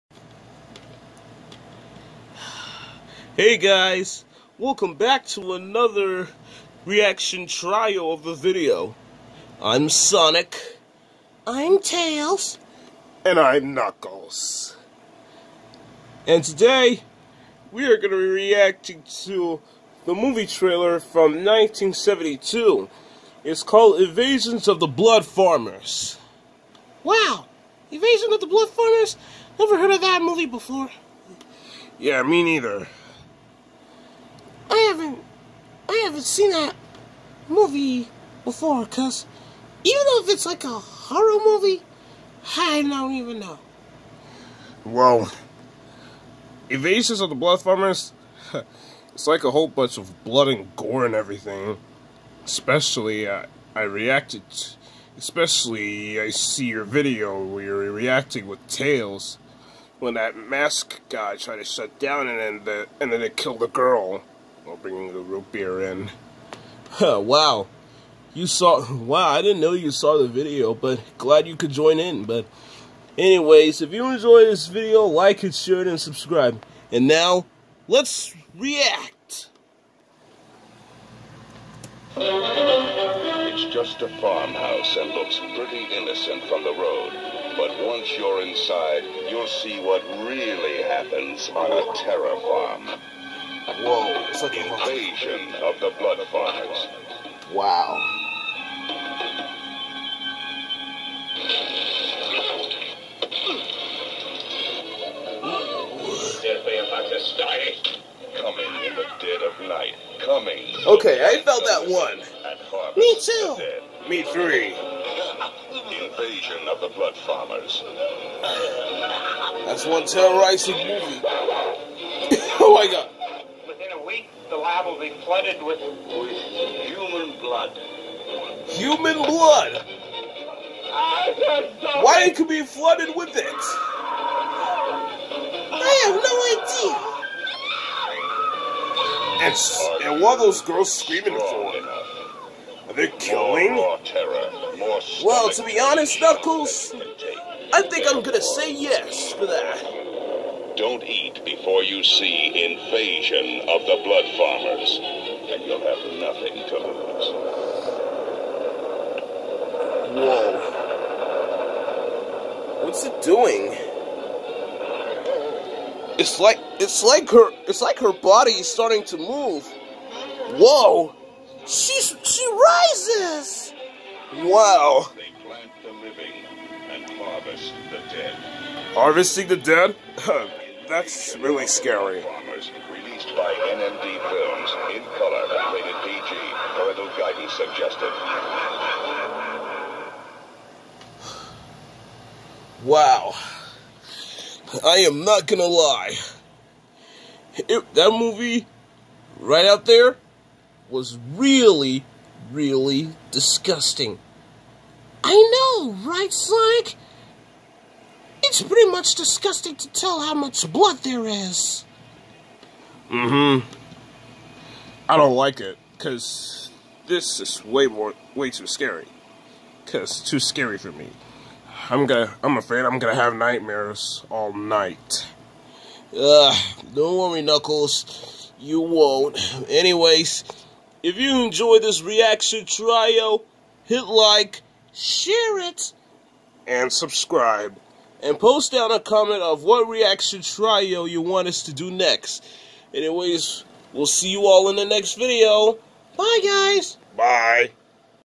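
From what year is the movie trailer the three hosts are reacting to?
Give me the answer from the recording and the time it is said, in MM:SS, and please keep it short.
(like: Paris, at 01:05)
1972, at 00:21.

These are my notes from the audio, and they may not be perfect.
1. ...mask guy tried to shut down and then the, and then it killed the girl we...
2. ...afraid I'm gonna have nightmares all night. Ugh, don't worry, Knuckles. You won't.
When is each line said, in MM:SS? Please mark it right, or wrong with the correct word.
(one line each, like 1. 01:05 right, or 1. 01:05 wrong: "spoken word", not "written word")
1. 01:00 right
2. 03:42 right.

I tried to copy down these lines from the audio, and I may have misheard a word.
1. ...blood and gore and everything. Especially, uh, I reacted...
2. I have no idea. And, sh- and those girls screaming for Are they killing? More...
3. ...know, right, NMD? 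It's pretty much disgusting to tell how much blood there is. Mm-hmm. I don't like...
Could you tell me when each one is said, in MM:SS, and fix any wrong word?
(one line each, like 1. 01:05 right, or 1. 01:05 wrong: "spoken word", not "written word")
1. 00:50 right
2. 02:15 right
3. 03:25 wrong: "Sonic", not "NMD".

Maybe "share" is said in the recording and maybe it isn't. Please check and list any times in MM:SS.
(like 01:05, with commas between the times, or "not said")
01:15, 03:54.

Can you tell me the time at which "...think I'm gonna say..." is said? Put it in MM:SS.
02:27.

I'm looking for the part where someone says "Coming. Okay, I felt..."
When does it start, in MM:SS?
01:50.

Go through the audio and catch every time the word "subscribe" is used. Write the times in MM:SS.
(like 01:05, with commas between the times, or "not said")
01:15, 03:56.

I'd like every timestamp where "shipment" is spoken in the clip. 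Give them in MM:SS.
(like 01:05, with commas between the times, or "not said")
not said.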